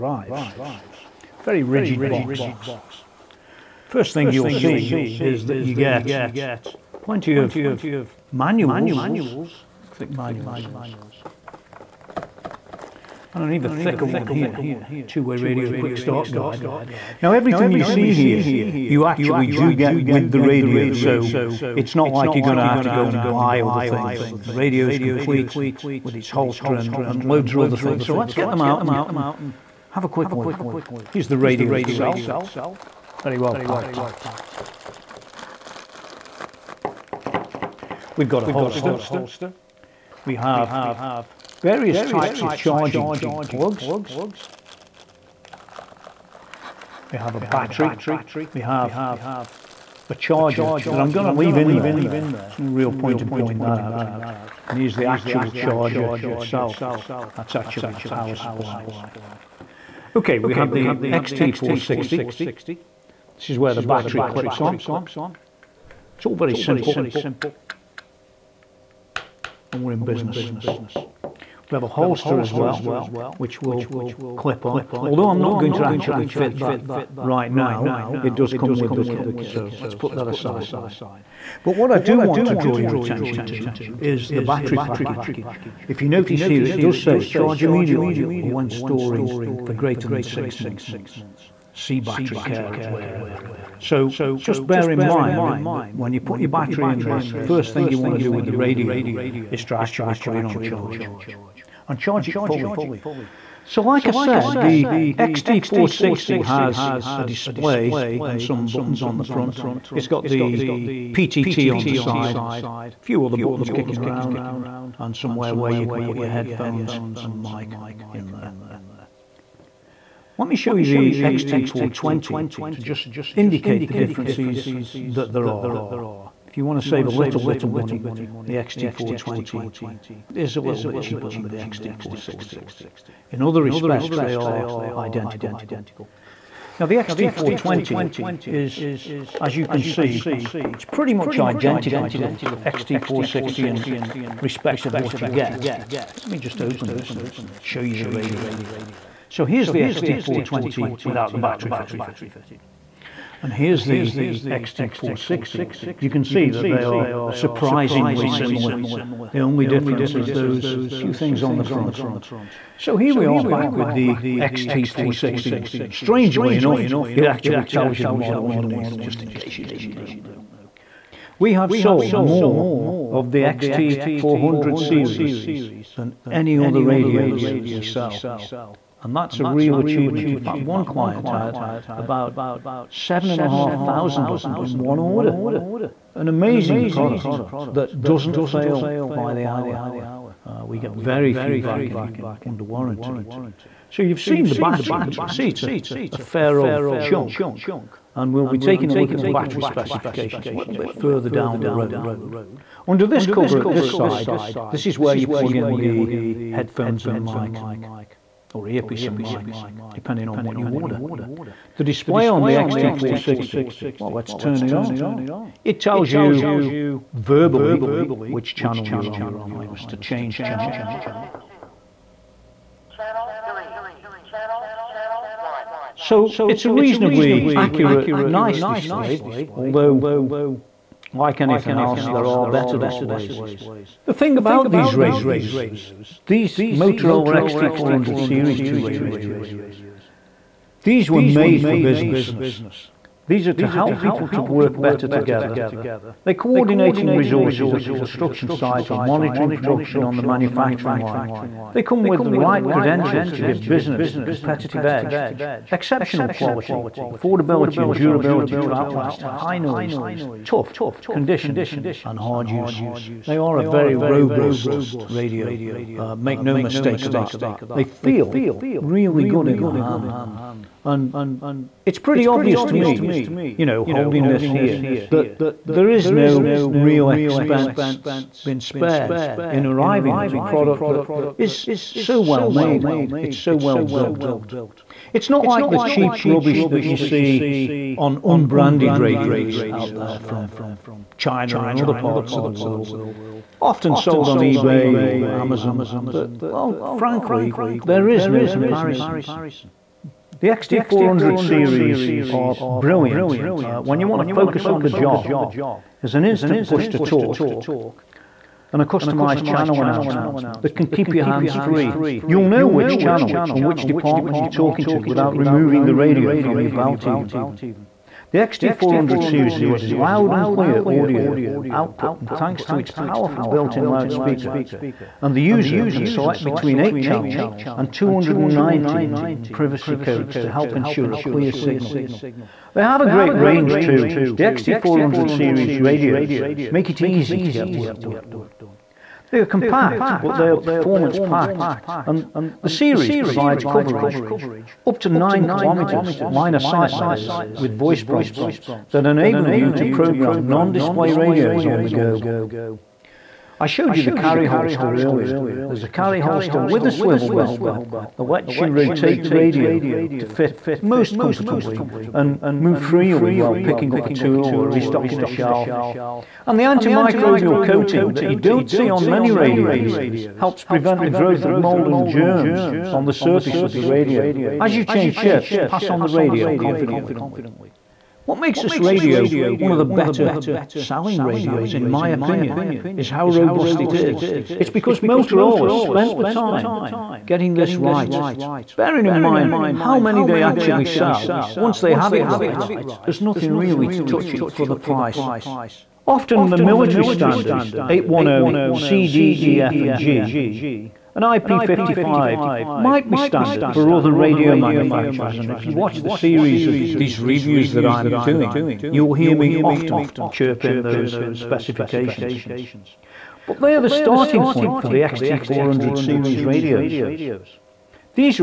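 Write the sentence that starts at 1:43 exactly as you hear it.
So like I said, the XT460 has a display and some buttons on the front.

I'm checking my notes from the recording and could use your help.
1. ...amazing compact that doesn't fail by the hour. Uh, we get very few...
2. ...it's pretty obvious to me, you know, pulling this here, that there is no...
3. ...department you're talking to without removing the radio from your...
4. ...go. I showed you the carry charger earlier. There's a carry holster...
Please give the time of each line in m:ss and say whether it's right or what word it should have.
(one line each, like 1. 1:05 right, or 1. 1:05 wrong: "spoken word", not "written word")
1. 3:06 wrong: "product", not "compact"
2. 4:31 wrong: "holding", not "pulling"
3. 5:13 right
4. 5:51 wrong: "holster", not "charger".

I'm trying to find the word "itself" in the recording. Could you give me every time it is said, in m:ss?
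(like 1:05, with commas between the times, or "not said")
0:31, 0:56.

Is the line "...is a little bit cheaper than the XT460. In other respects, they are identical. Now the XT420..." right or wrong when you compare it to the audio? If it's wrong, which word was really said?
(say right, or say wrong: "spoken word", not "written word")
right.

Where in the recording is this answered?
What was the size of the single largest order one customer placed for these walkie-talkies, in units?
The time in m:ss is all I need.
3:02.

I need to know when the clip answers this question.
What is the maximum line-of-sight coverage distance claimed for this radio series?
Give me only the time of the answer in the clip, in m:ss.
5:45.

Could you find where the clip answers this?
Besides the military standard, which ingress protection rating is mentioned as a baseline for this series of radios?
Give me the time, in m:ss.
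6:41.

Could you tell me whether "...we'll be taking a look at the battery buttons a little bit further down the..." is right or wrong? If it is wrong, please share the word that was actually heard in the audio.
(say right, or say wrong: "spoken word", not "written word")
wrong: "specifications", not "buttons".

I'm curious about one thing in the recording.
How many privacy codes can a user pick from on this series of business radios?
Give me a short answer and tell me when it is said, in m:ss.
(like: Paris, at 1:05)
219, at 5:27.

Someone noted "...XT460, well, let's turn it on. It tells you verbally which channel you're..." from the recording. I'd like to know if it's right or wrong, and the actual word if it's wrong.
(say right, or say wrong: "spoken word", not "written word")
right.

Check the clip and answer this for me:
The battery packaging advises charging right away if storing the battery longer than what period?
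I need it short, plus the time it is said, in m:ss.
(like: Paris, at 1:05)
6 months, at 1:30.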